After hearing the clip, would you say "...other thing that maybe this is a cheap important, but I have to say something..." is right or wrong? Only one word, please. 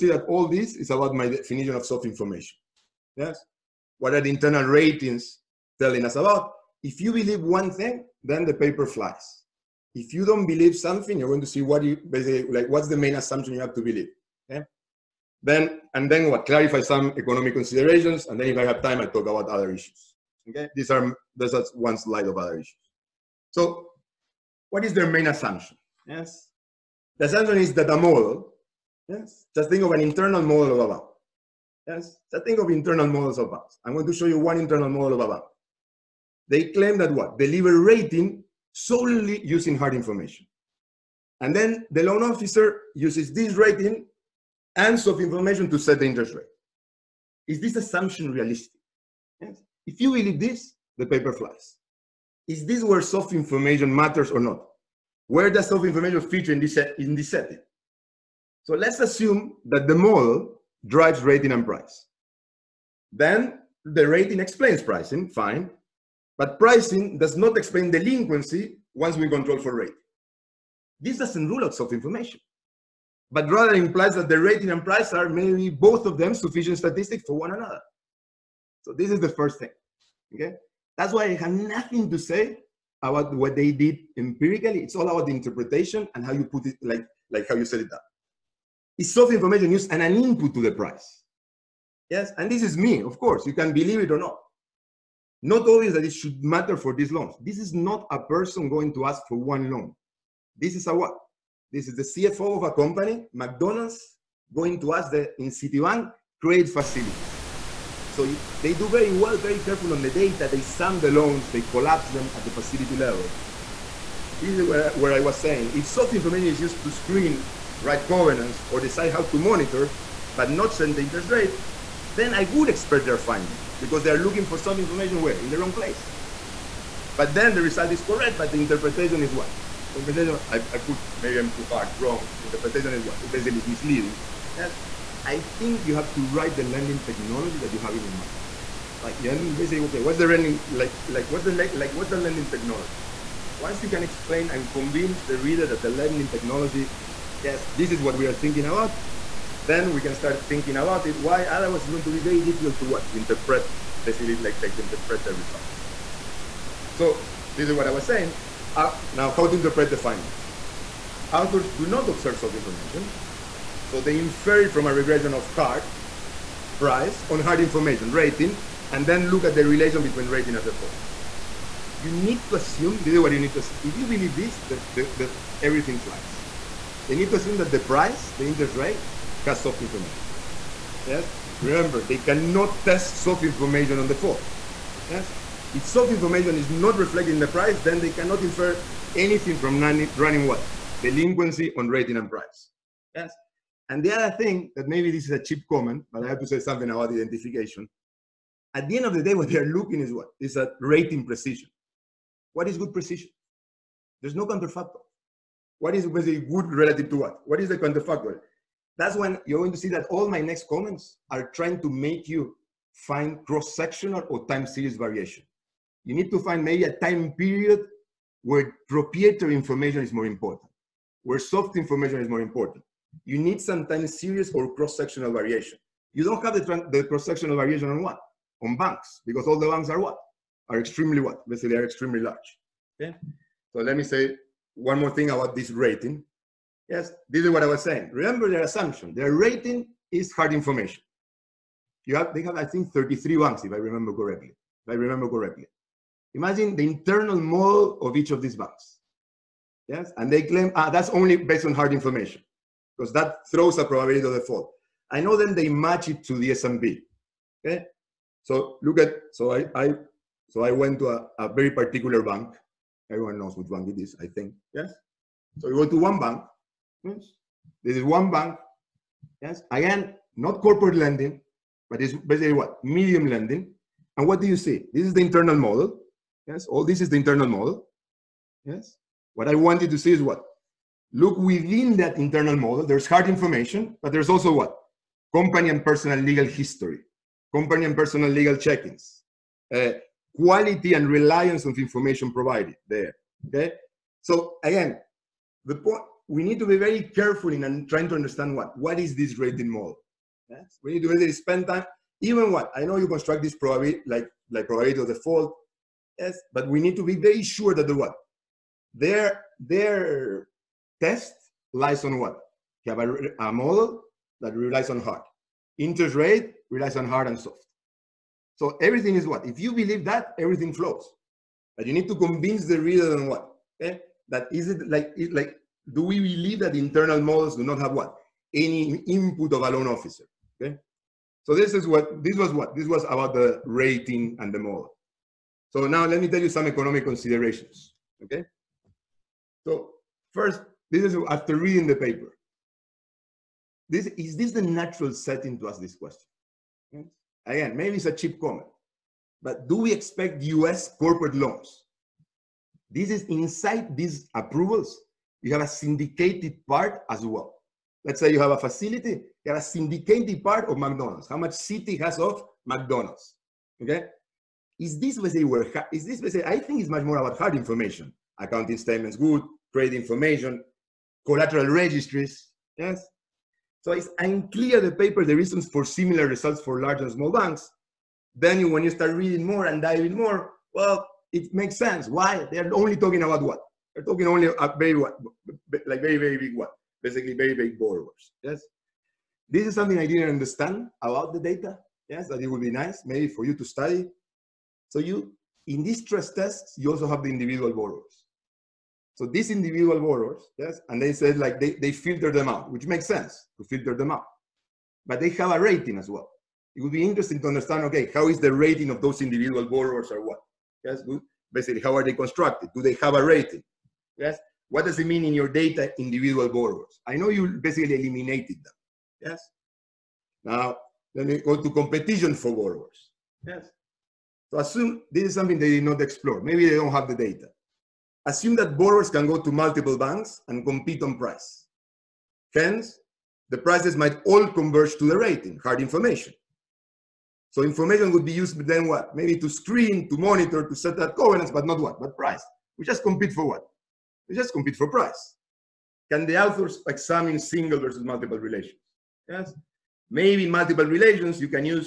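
wrong.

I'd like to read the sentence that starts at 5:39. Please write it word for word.
So first, this is after reading the paper.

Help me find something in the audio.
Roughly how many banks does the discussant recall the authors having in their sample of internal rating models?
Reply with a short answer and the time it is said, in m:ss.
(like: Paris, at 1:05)
33, at 4:02.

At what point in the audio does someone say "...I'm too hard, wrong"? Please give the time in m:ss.
2:11.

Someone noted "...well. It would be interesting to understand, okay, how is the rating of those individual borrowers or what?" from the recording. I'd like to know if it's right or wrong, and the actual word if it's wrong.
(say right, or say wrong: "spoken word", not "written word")
right.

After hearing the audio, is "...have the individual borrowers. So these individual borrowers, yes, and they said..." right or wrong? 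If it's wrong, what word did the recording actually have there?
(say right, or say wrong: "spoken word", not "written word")
right.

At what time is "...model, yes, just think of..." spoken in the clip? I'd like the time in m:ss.
0:27.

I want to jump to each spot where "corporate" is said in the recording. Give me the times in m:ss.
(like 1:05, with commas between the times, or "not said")
4:30, 5:50.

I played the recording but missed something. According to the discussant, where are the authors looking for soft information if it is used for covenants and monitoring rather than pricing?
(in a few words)
in the wrong place.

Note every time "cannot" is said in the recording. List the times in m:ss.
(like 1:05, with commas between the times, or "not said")
3:02, 3:08.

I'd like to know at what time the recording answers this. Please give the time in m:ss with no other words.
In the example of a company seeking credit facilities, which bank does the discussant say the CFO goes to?
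1:45.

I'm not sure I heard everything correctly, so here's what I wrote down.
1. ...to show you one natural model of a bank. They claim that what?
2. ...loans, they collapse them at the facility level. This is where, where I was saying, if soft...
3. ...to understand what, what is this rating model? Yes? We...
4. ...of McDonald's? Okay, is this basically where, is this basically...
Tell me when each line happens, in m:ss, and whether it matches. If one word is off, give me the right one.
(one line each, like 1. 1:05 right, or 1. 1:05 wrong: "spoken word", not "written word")
1. 0:34 wrong: "internal", not "natural"
2. 1:51 right
3. 4:58 right
4. 6:02 right.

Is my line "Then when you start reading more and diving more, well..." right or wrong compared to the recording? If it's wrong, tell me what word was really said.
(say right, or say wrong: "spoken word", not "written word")
right.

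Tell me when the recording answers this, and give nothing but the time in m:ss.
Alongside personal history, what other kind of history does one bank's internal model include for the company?
4:46.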